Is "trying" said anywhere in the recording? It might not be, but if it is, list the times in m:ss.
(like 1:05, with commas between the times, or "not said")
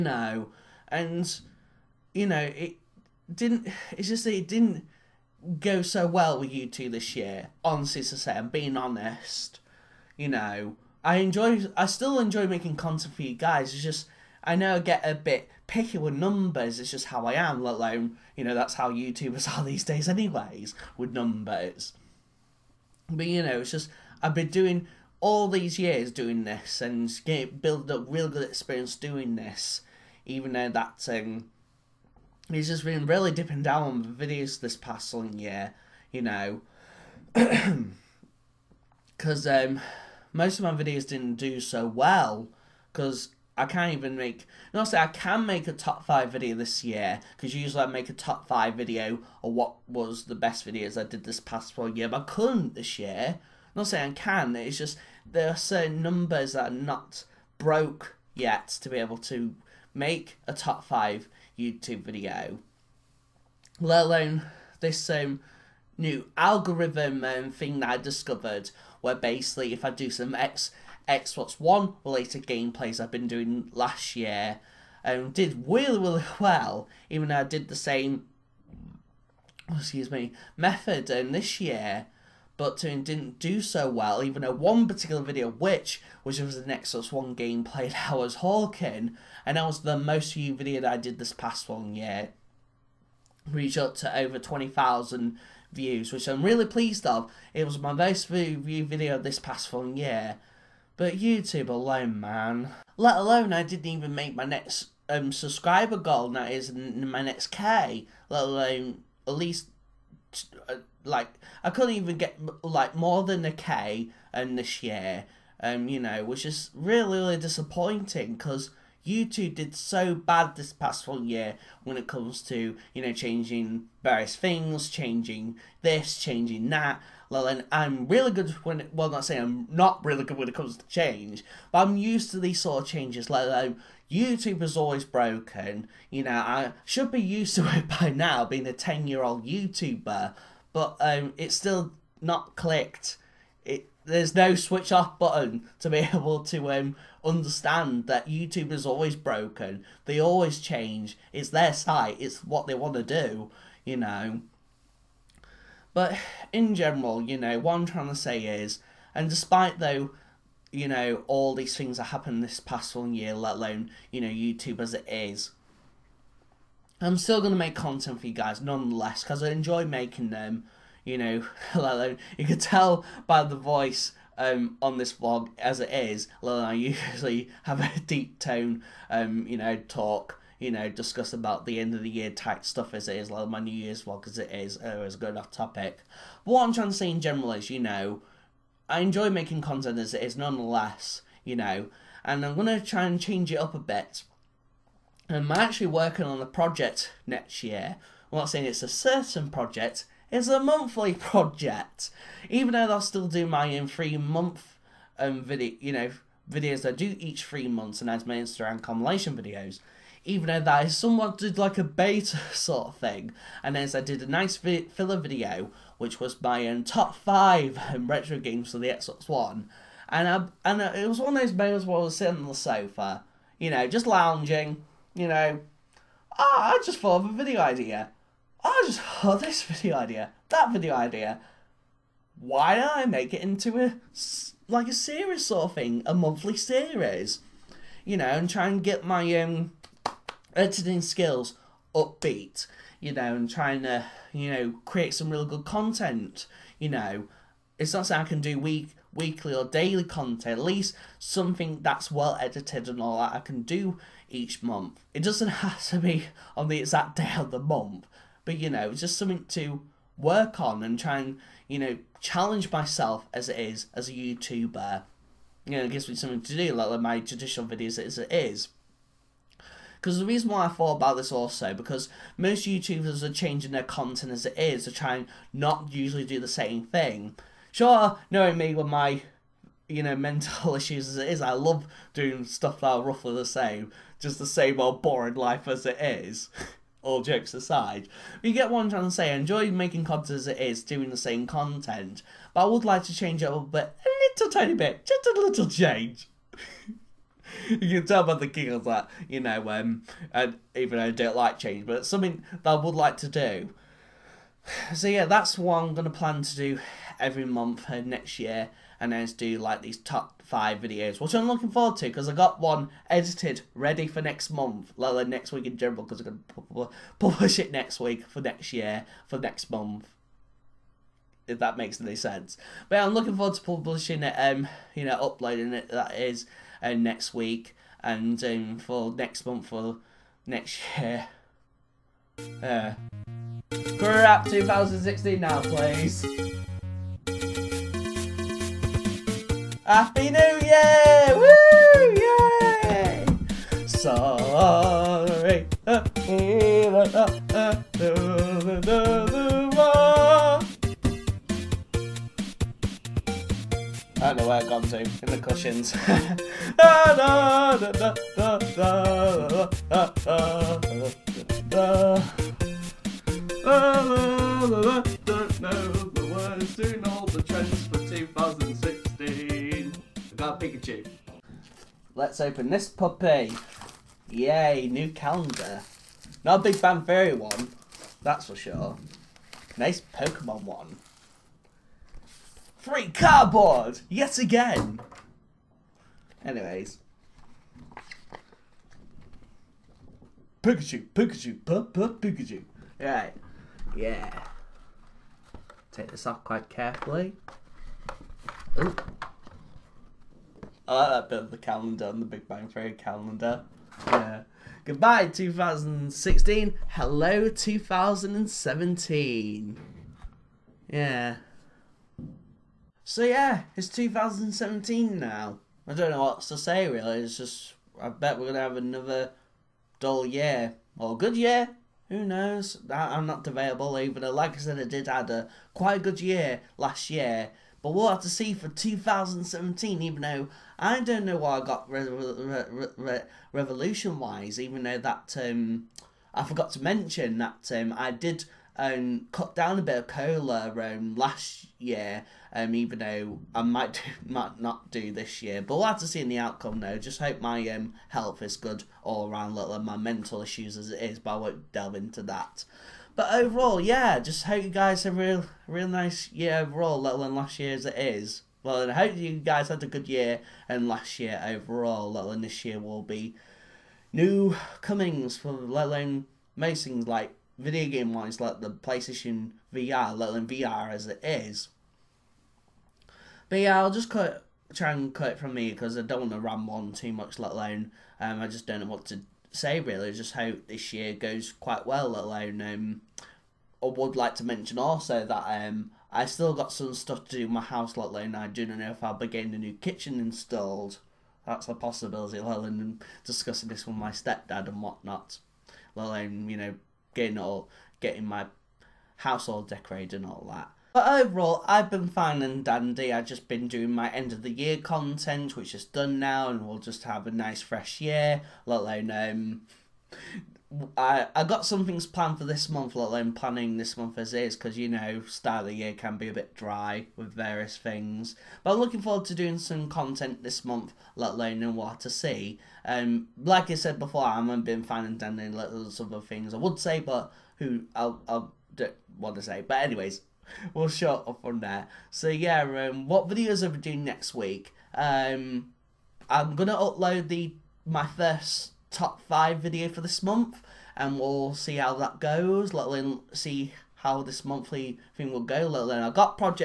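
2:37, 3:06, 4:03, 4:48.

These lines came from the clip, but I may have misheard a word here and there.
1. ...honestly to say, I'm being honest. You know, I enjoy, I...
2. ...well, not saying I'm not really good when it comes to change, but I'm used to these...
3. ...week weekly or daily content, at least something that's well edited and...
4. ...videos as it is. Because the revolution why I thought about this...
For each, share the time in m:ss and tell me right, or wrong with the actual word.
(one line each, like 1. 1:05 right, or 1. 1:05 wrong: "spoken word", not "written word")
1. 0:07 right
2. 2:08 right
3. 4:08 right
4. 4:27 wrong: "reason", not "revolution".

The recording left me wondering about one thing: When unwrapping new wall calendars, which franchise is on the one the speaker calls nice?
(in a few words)
Pokemon.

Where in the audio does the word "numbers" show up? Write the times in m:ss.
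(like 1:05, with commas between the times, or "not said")
0:16, 0:21, 0:56.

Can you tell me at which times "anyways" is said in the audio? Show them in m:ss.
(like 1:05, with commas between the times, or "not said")
0:20, 6:26, 8:49.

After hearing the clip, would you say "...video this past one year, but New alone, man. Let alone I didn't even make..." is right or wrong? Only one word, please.
wrong.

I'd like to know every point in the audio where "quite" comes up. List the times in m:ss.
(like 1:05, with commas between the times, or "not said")
6:36, 7:05, 8:01.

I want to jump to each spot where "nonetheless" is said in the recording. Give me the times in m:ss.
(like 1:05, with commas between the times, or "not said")
2:48, 3:10.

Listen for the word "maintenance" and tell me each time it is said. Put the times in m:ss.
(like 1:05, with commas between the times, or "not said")
not said.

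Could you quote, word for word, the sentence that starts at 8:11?
That's a possibility, let alone discussing this with my stepdad and whatnot.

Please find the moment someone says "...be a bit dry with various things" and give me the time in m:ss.
8:36.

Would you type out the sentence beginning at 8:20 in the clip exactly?
But overall, I've been fine and dandy.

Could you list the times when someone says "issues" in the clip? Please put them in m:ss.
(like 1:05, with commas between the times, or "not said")
4:40, 7:30.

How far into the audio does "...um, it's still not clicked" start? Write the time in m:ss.
2:20.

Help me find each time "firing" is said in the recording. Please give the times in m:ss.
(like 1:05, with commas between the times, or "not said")
not said.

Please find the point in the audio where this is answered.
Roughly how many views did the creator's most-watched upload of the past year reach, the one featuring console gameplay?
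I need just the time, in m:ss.
1:34.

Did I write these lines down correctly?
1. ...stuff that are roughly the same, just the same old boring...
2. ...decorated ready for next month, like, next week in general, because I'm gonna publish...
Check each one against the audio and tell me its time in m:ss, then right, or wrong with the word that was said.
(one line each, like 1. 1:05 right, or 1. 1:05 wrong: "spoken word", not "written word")
1. 4:42 right
2. 5:13 wrong: "edited", not "decorated".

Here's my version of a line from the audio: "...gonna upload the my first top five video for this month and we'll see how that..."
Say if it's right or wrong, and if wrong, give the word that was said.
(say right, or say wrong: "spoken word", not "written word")
right.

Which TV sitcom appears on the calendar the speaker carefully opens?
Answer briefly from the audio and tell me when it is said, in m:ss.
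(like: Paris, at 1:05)
The Big Bang Theory, at 6:42.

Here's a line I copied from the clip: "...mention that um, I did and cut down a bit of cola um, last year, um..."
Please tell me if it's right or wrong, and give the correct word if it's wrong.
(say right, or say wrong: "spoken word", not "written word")
right.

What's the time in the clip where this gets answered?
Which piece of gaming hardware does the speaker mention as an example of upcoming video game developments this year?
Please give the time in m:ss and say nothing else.
7:48.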